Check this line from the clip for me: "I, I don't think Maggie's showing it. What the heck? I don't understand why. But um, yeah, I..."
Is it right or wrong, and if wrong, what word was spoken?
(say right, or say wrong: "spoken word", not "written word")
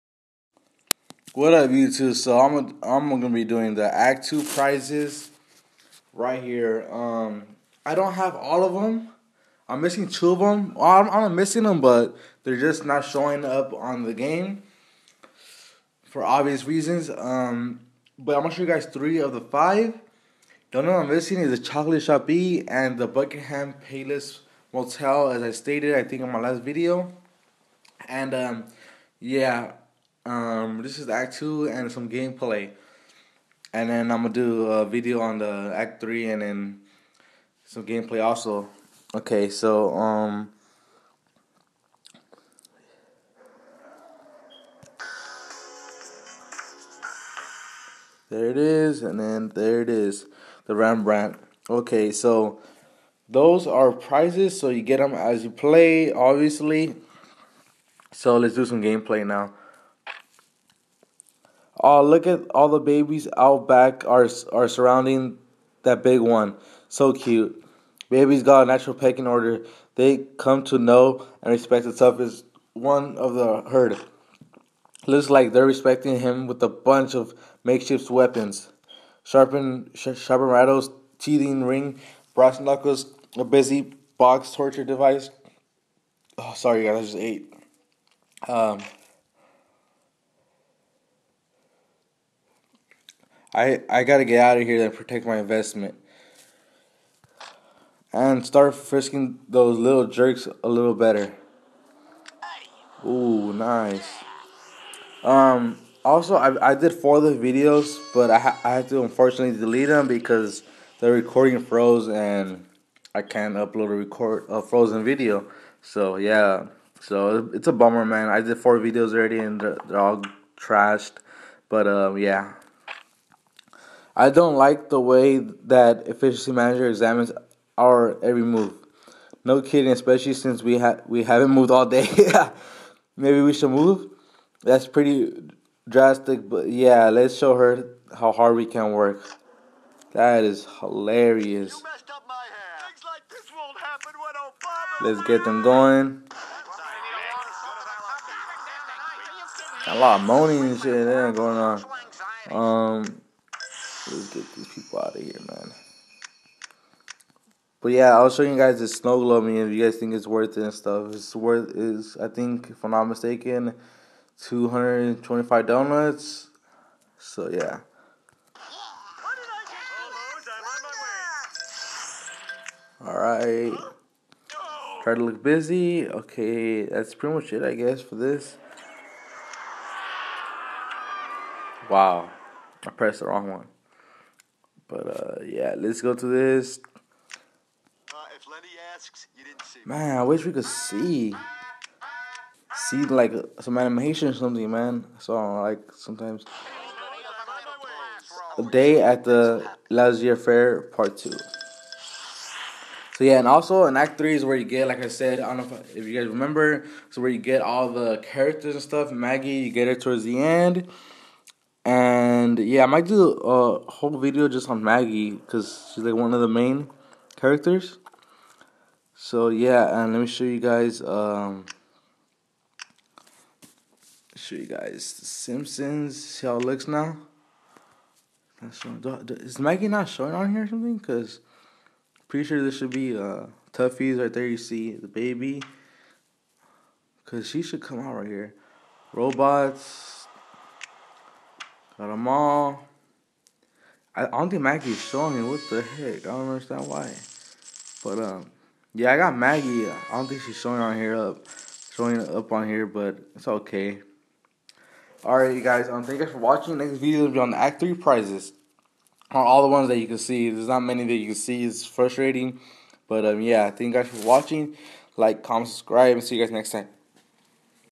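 right.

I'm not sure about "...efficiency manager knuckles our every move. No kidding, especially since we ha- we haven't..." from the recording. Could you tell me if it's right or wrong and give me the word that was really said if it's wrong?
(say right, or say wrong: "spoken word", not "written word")
wrong: "examines", not "knuckles".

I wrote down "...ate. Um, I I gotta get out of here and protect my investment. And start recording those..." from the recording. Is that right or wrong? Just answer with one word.
wrong.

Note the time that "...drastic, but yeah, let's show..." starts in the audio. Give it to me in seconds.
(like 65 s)
135 s.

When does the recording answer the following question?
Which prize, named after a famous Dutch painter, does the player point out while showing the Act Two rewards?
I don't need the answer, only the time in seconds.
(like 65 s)
50 s.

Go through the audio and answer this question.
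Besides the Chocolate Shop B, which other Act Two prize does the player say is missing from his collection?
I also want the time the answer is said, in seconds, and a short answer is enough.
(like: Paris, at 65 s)
Buckingham Palace Motel, at 23 s.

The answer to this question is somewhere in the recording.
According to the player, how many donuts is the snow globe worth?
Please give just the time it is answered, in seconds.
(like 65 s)
164 s.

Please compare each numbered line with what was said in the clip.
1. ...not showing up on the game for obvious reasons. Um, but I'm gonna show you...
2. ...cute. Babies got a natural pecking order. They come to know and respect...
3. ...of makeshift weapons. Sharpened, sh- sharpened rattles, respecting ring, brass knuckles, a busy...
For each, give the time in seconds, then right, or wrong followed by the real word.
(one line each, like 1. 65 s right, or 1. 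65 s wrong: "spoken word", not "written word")
1. 12 s right
2. 67 s right
3. 77 s wrong: "teething", not "respecting".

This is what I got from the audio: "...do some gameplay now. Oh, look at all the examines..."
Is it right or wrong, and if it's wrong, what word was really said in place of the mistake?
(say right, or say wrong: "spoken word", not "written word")
wrong: "babies", not "examines".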